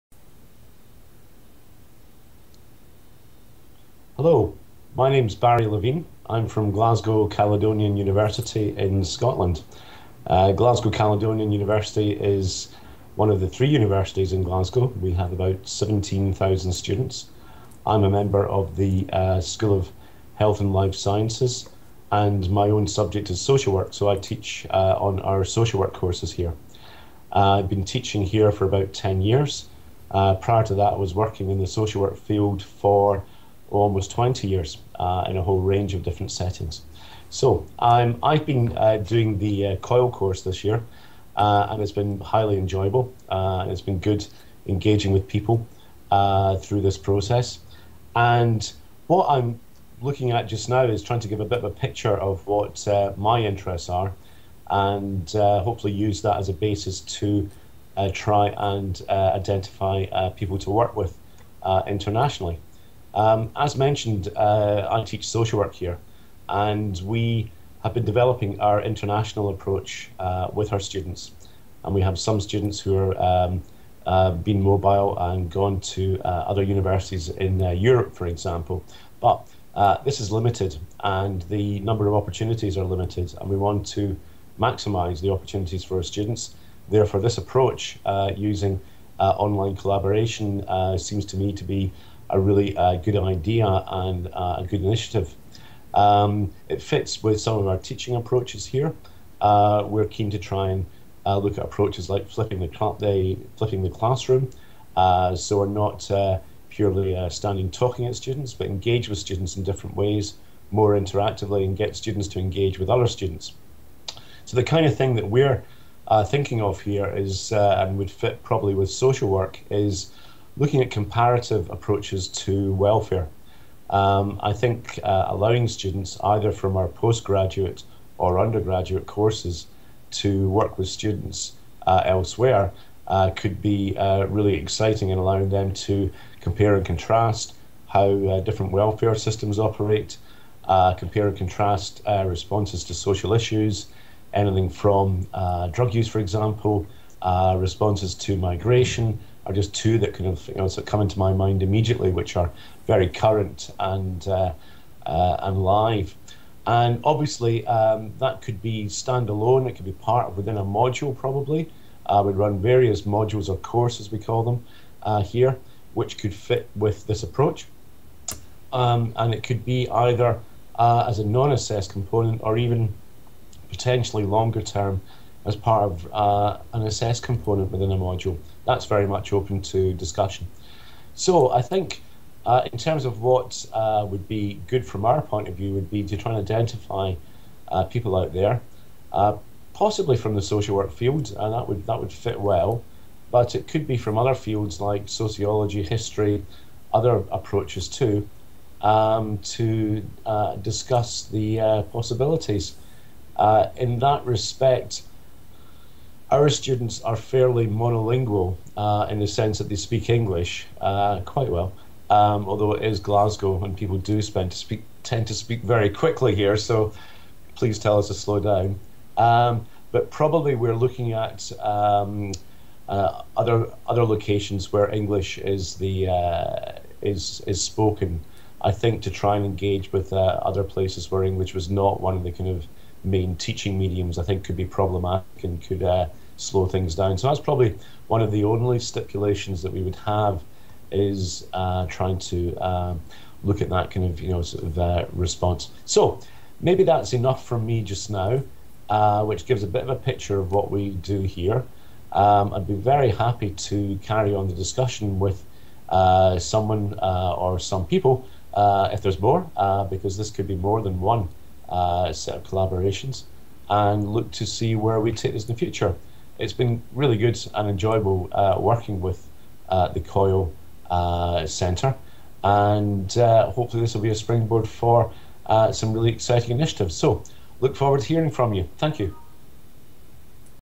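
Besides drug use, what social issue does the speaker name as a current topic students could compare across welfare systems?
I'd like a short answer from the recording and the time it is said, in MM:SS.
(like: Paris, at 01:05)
migration, at 02:28.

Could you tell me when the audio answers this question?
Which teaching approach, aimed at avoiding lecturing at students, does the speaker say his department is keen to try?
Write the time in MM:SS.
01:43.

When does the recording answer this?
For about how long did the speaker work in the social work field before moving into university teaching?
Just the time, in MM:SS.
00:33.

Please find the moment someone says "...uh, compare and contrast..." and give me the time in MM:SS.
02:20.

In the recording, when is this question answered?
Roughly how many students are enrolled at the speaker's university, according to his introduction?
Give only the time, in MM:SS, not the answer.
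00:15.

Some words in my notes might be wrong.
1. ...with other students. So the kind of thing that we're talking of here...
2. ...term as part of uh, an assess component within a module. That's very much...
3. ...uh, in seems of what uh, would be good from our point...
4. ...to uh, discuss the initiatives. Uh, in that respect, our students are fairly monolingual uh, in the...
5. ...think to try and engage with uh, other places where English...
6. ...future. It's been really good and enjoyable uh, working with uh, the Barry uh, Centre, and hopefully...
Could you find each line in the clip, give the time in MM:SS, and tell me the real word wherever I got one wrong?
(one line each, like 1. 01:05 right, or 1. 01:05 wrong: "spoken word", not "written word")
1. 01:52 wrong: "thinking", not "talking"
2. 02:54 right
3. 03:02 wrong: "terms", not "seems"
4. 03:19 wrong: "possibilities", not "initiatives"
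5. 03:48 right
6. 04:25 wrong: "COIL", not "Barry".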